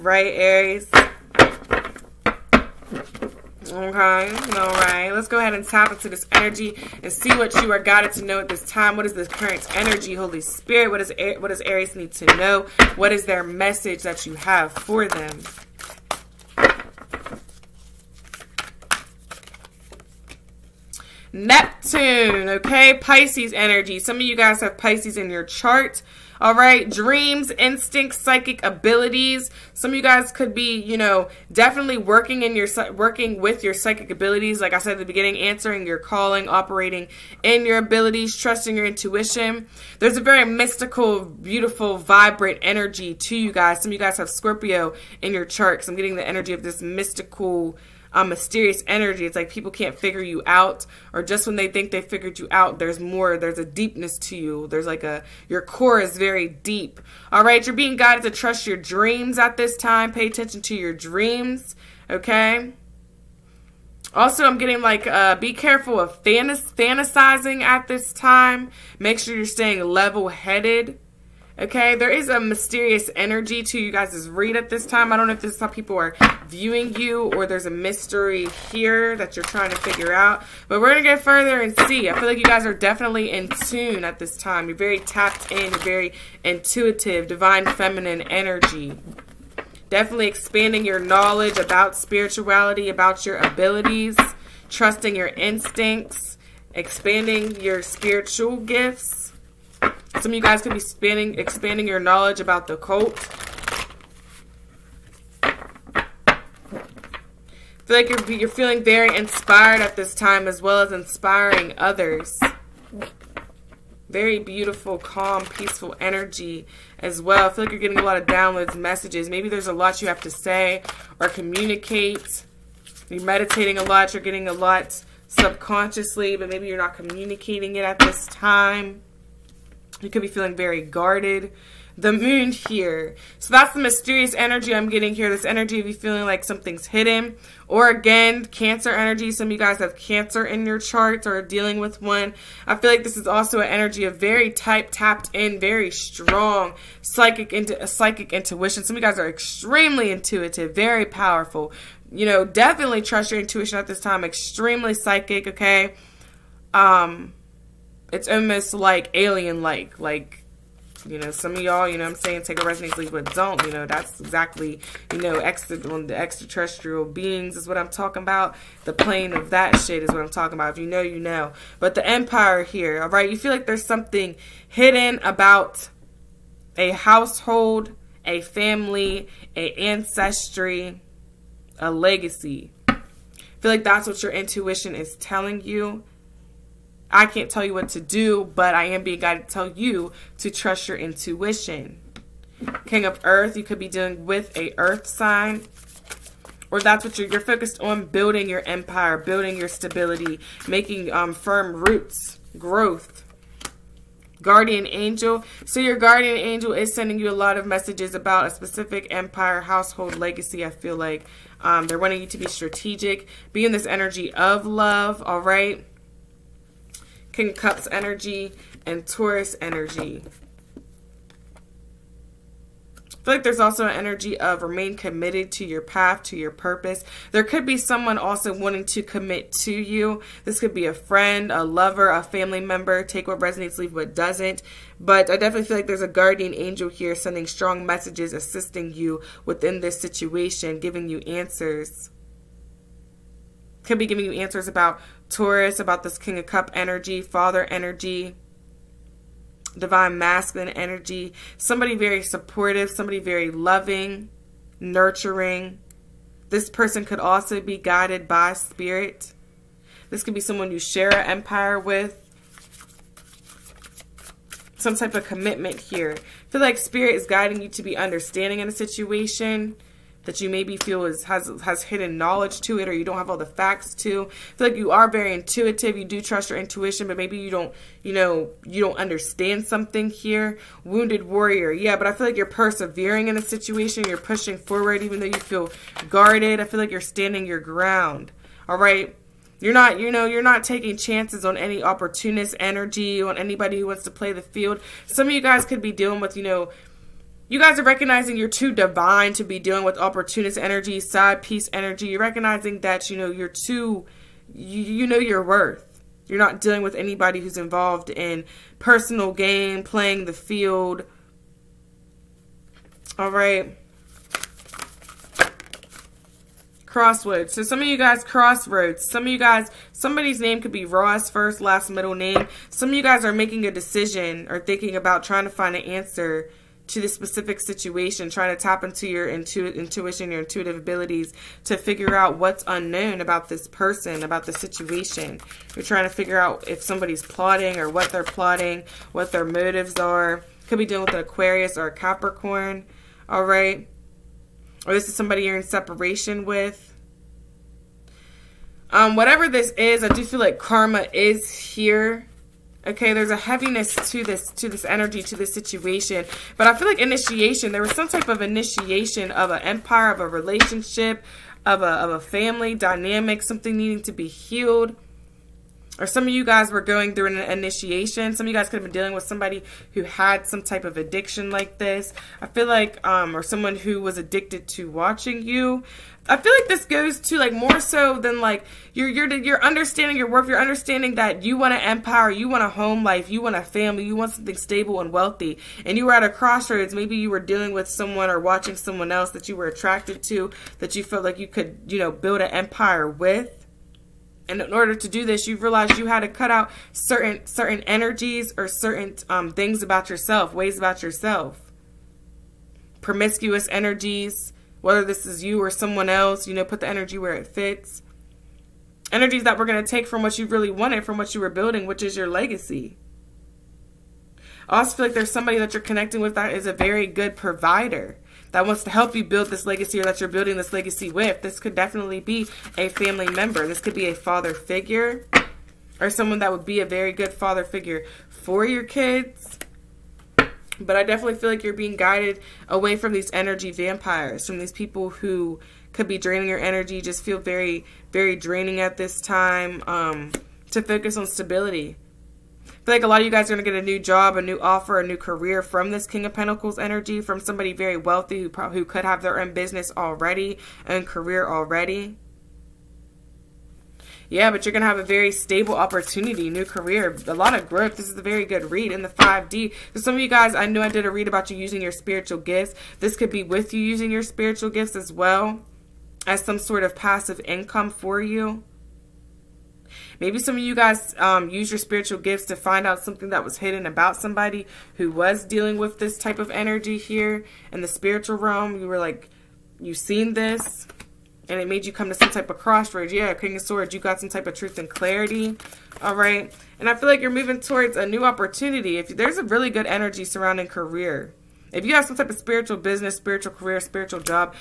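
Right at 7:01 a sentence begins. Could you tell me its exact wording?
This could definitely be a family member.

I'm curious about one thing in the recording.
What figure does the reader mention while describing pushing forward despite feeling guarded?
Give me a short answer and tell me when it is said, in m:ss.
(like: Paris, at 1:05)
Wounded warrior, at 4:40.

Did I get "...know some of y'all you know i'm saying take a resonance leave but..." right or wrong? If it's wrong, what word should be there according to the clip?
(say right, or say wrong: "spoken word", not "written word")
right.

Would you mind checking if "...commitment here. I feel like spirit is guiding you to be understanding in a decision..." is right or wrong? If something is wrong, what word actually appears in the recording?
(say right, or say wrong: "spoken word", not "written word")
wrong: "situation", not "decision".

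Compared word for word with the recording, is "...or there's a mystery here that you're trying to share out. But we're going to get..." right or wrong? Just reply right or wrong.
wrong.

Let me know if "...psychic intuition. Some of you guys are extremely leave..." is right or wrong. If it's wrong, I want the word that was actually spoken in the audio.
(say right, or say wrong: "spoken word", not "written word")
wrong: "intuitive", not "leave".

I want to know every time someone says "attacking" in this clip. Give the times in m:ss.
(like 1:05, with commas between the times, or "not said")
not said.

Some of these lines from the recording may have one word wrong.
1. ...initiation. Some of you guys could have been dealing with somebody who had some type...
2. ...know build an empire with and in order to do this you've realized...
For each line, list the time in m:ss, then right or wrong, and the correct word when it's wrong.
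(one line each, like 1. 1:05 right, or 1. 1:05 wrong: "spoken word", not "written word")
1. 6:07 right
2. 6:31 right.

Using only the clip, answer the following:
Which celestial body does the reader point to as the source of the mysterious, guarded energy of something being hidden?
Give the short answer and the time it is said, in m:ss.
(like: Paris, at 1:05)
The moon, at 2:11.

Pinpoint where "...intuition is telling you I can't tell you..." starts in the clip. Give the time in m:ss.
3:04.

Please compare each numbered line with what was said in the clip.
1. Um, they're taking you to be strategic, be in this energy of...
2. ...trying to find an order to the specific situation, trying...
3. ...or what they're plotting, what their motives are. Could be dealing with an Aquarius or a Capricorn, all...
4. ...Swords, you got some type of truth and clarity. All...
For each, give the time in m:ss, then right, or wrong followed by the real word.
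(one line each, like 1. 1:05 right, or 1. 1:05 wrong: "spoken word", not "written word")
1. 3:31 wrong: "wanting", not "taking"
2. 5:25 wrong: "answer", not "order"
3. 5:37 right
4. 8:03 right.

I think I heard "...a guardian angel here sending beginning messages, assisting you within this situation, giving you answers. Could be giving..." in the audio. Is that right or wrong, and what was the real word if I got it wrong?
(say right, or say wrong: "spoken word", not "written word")
wrong: "strong", not "beginning".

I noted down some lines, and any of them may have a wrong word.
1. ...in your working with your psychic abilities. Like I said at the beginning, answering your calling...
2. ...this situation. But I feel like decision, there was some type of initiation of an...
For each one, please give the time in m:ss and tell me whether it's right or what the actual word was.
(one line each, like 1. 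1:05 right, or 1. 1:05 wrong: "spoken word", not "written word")
1. 0:32 right
2. 5:55 wrong: "initiation", not "decision".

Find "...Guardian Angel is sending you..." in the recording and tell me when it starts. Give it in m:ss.
3:25.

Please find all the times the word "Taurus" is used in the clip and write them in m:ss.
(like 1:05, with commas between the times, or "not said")
3:39, 4:05.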